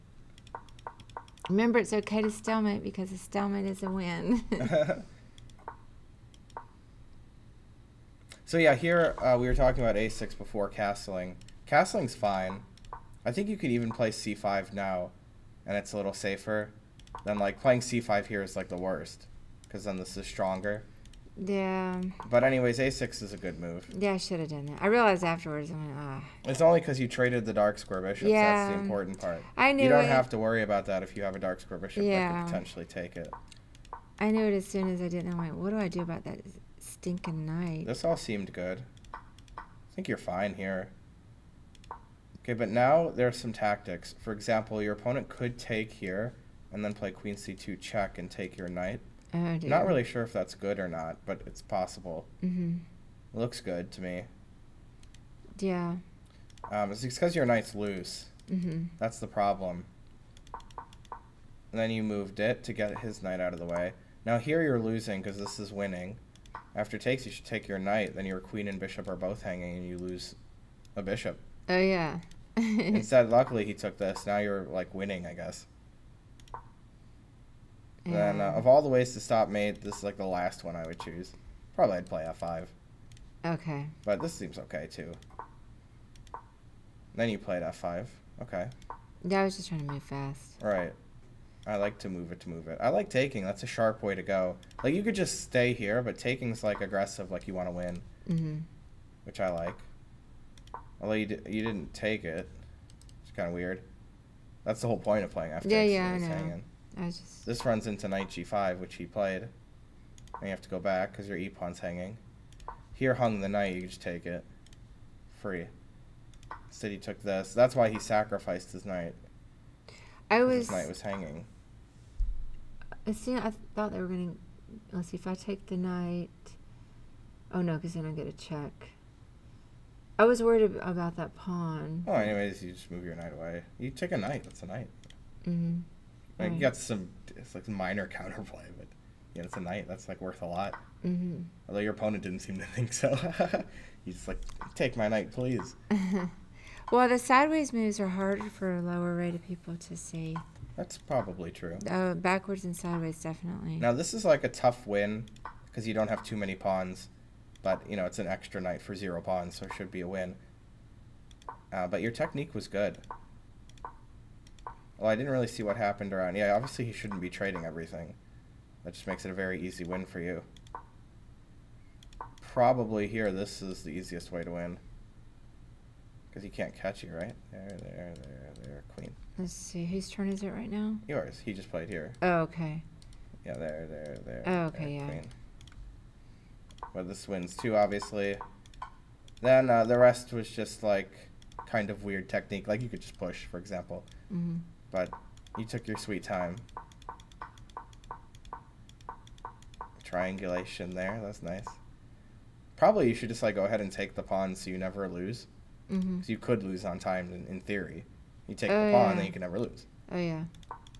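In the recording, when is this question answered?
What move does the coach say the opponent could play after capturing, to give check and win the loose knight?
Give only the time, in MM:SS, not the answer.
00:47.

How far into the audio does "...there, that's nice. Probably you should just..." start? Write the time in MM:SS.
03:20.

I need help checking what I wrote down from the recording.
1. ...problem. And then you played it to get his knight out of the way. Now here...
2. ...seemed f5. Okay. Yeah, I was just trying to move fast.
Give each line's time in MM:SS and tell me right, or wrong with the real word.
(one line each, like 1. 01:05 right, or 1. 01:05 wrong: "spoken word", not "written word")
1. 00:59 wrong: "moved", not "played"
2. 01:27 wrong: "played", not "seemed".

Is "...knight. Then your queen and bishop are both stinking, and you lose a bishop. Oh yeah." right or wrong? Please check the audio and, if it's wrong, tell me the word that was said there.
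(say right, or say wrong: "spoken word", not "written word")
wrong: "hanging", not "stinking".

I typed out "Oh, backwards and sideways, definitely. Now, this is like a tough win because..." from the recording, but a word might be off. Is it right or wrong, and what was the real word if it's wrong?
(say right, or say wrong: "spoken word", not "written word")
right.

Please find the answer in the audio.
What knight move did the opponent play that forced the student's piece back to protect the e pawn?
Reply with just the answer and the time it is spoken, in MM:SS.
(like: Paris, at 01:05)
knight g5, at 01:48.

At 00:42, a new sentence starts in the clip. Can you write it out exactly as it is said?
Okay, but now there are some tactics.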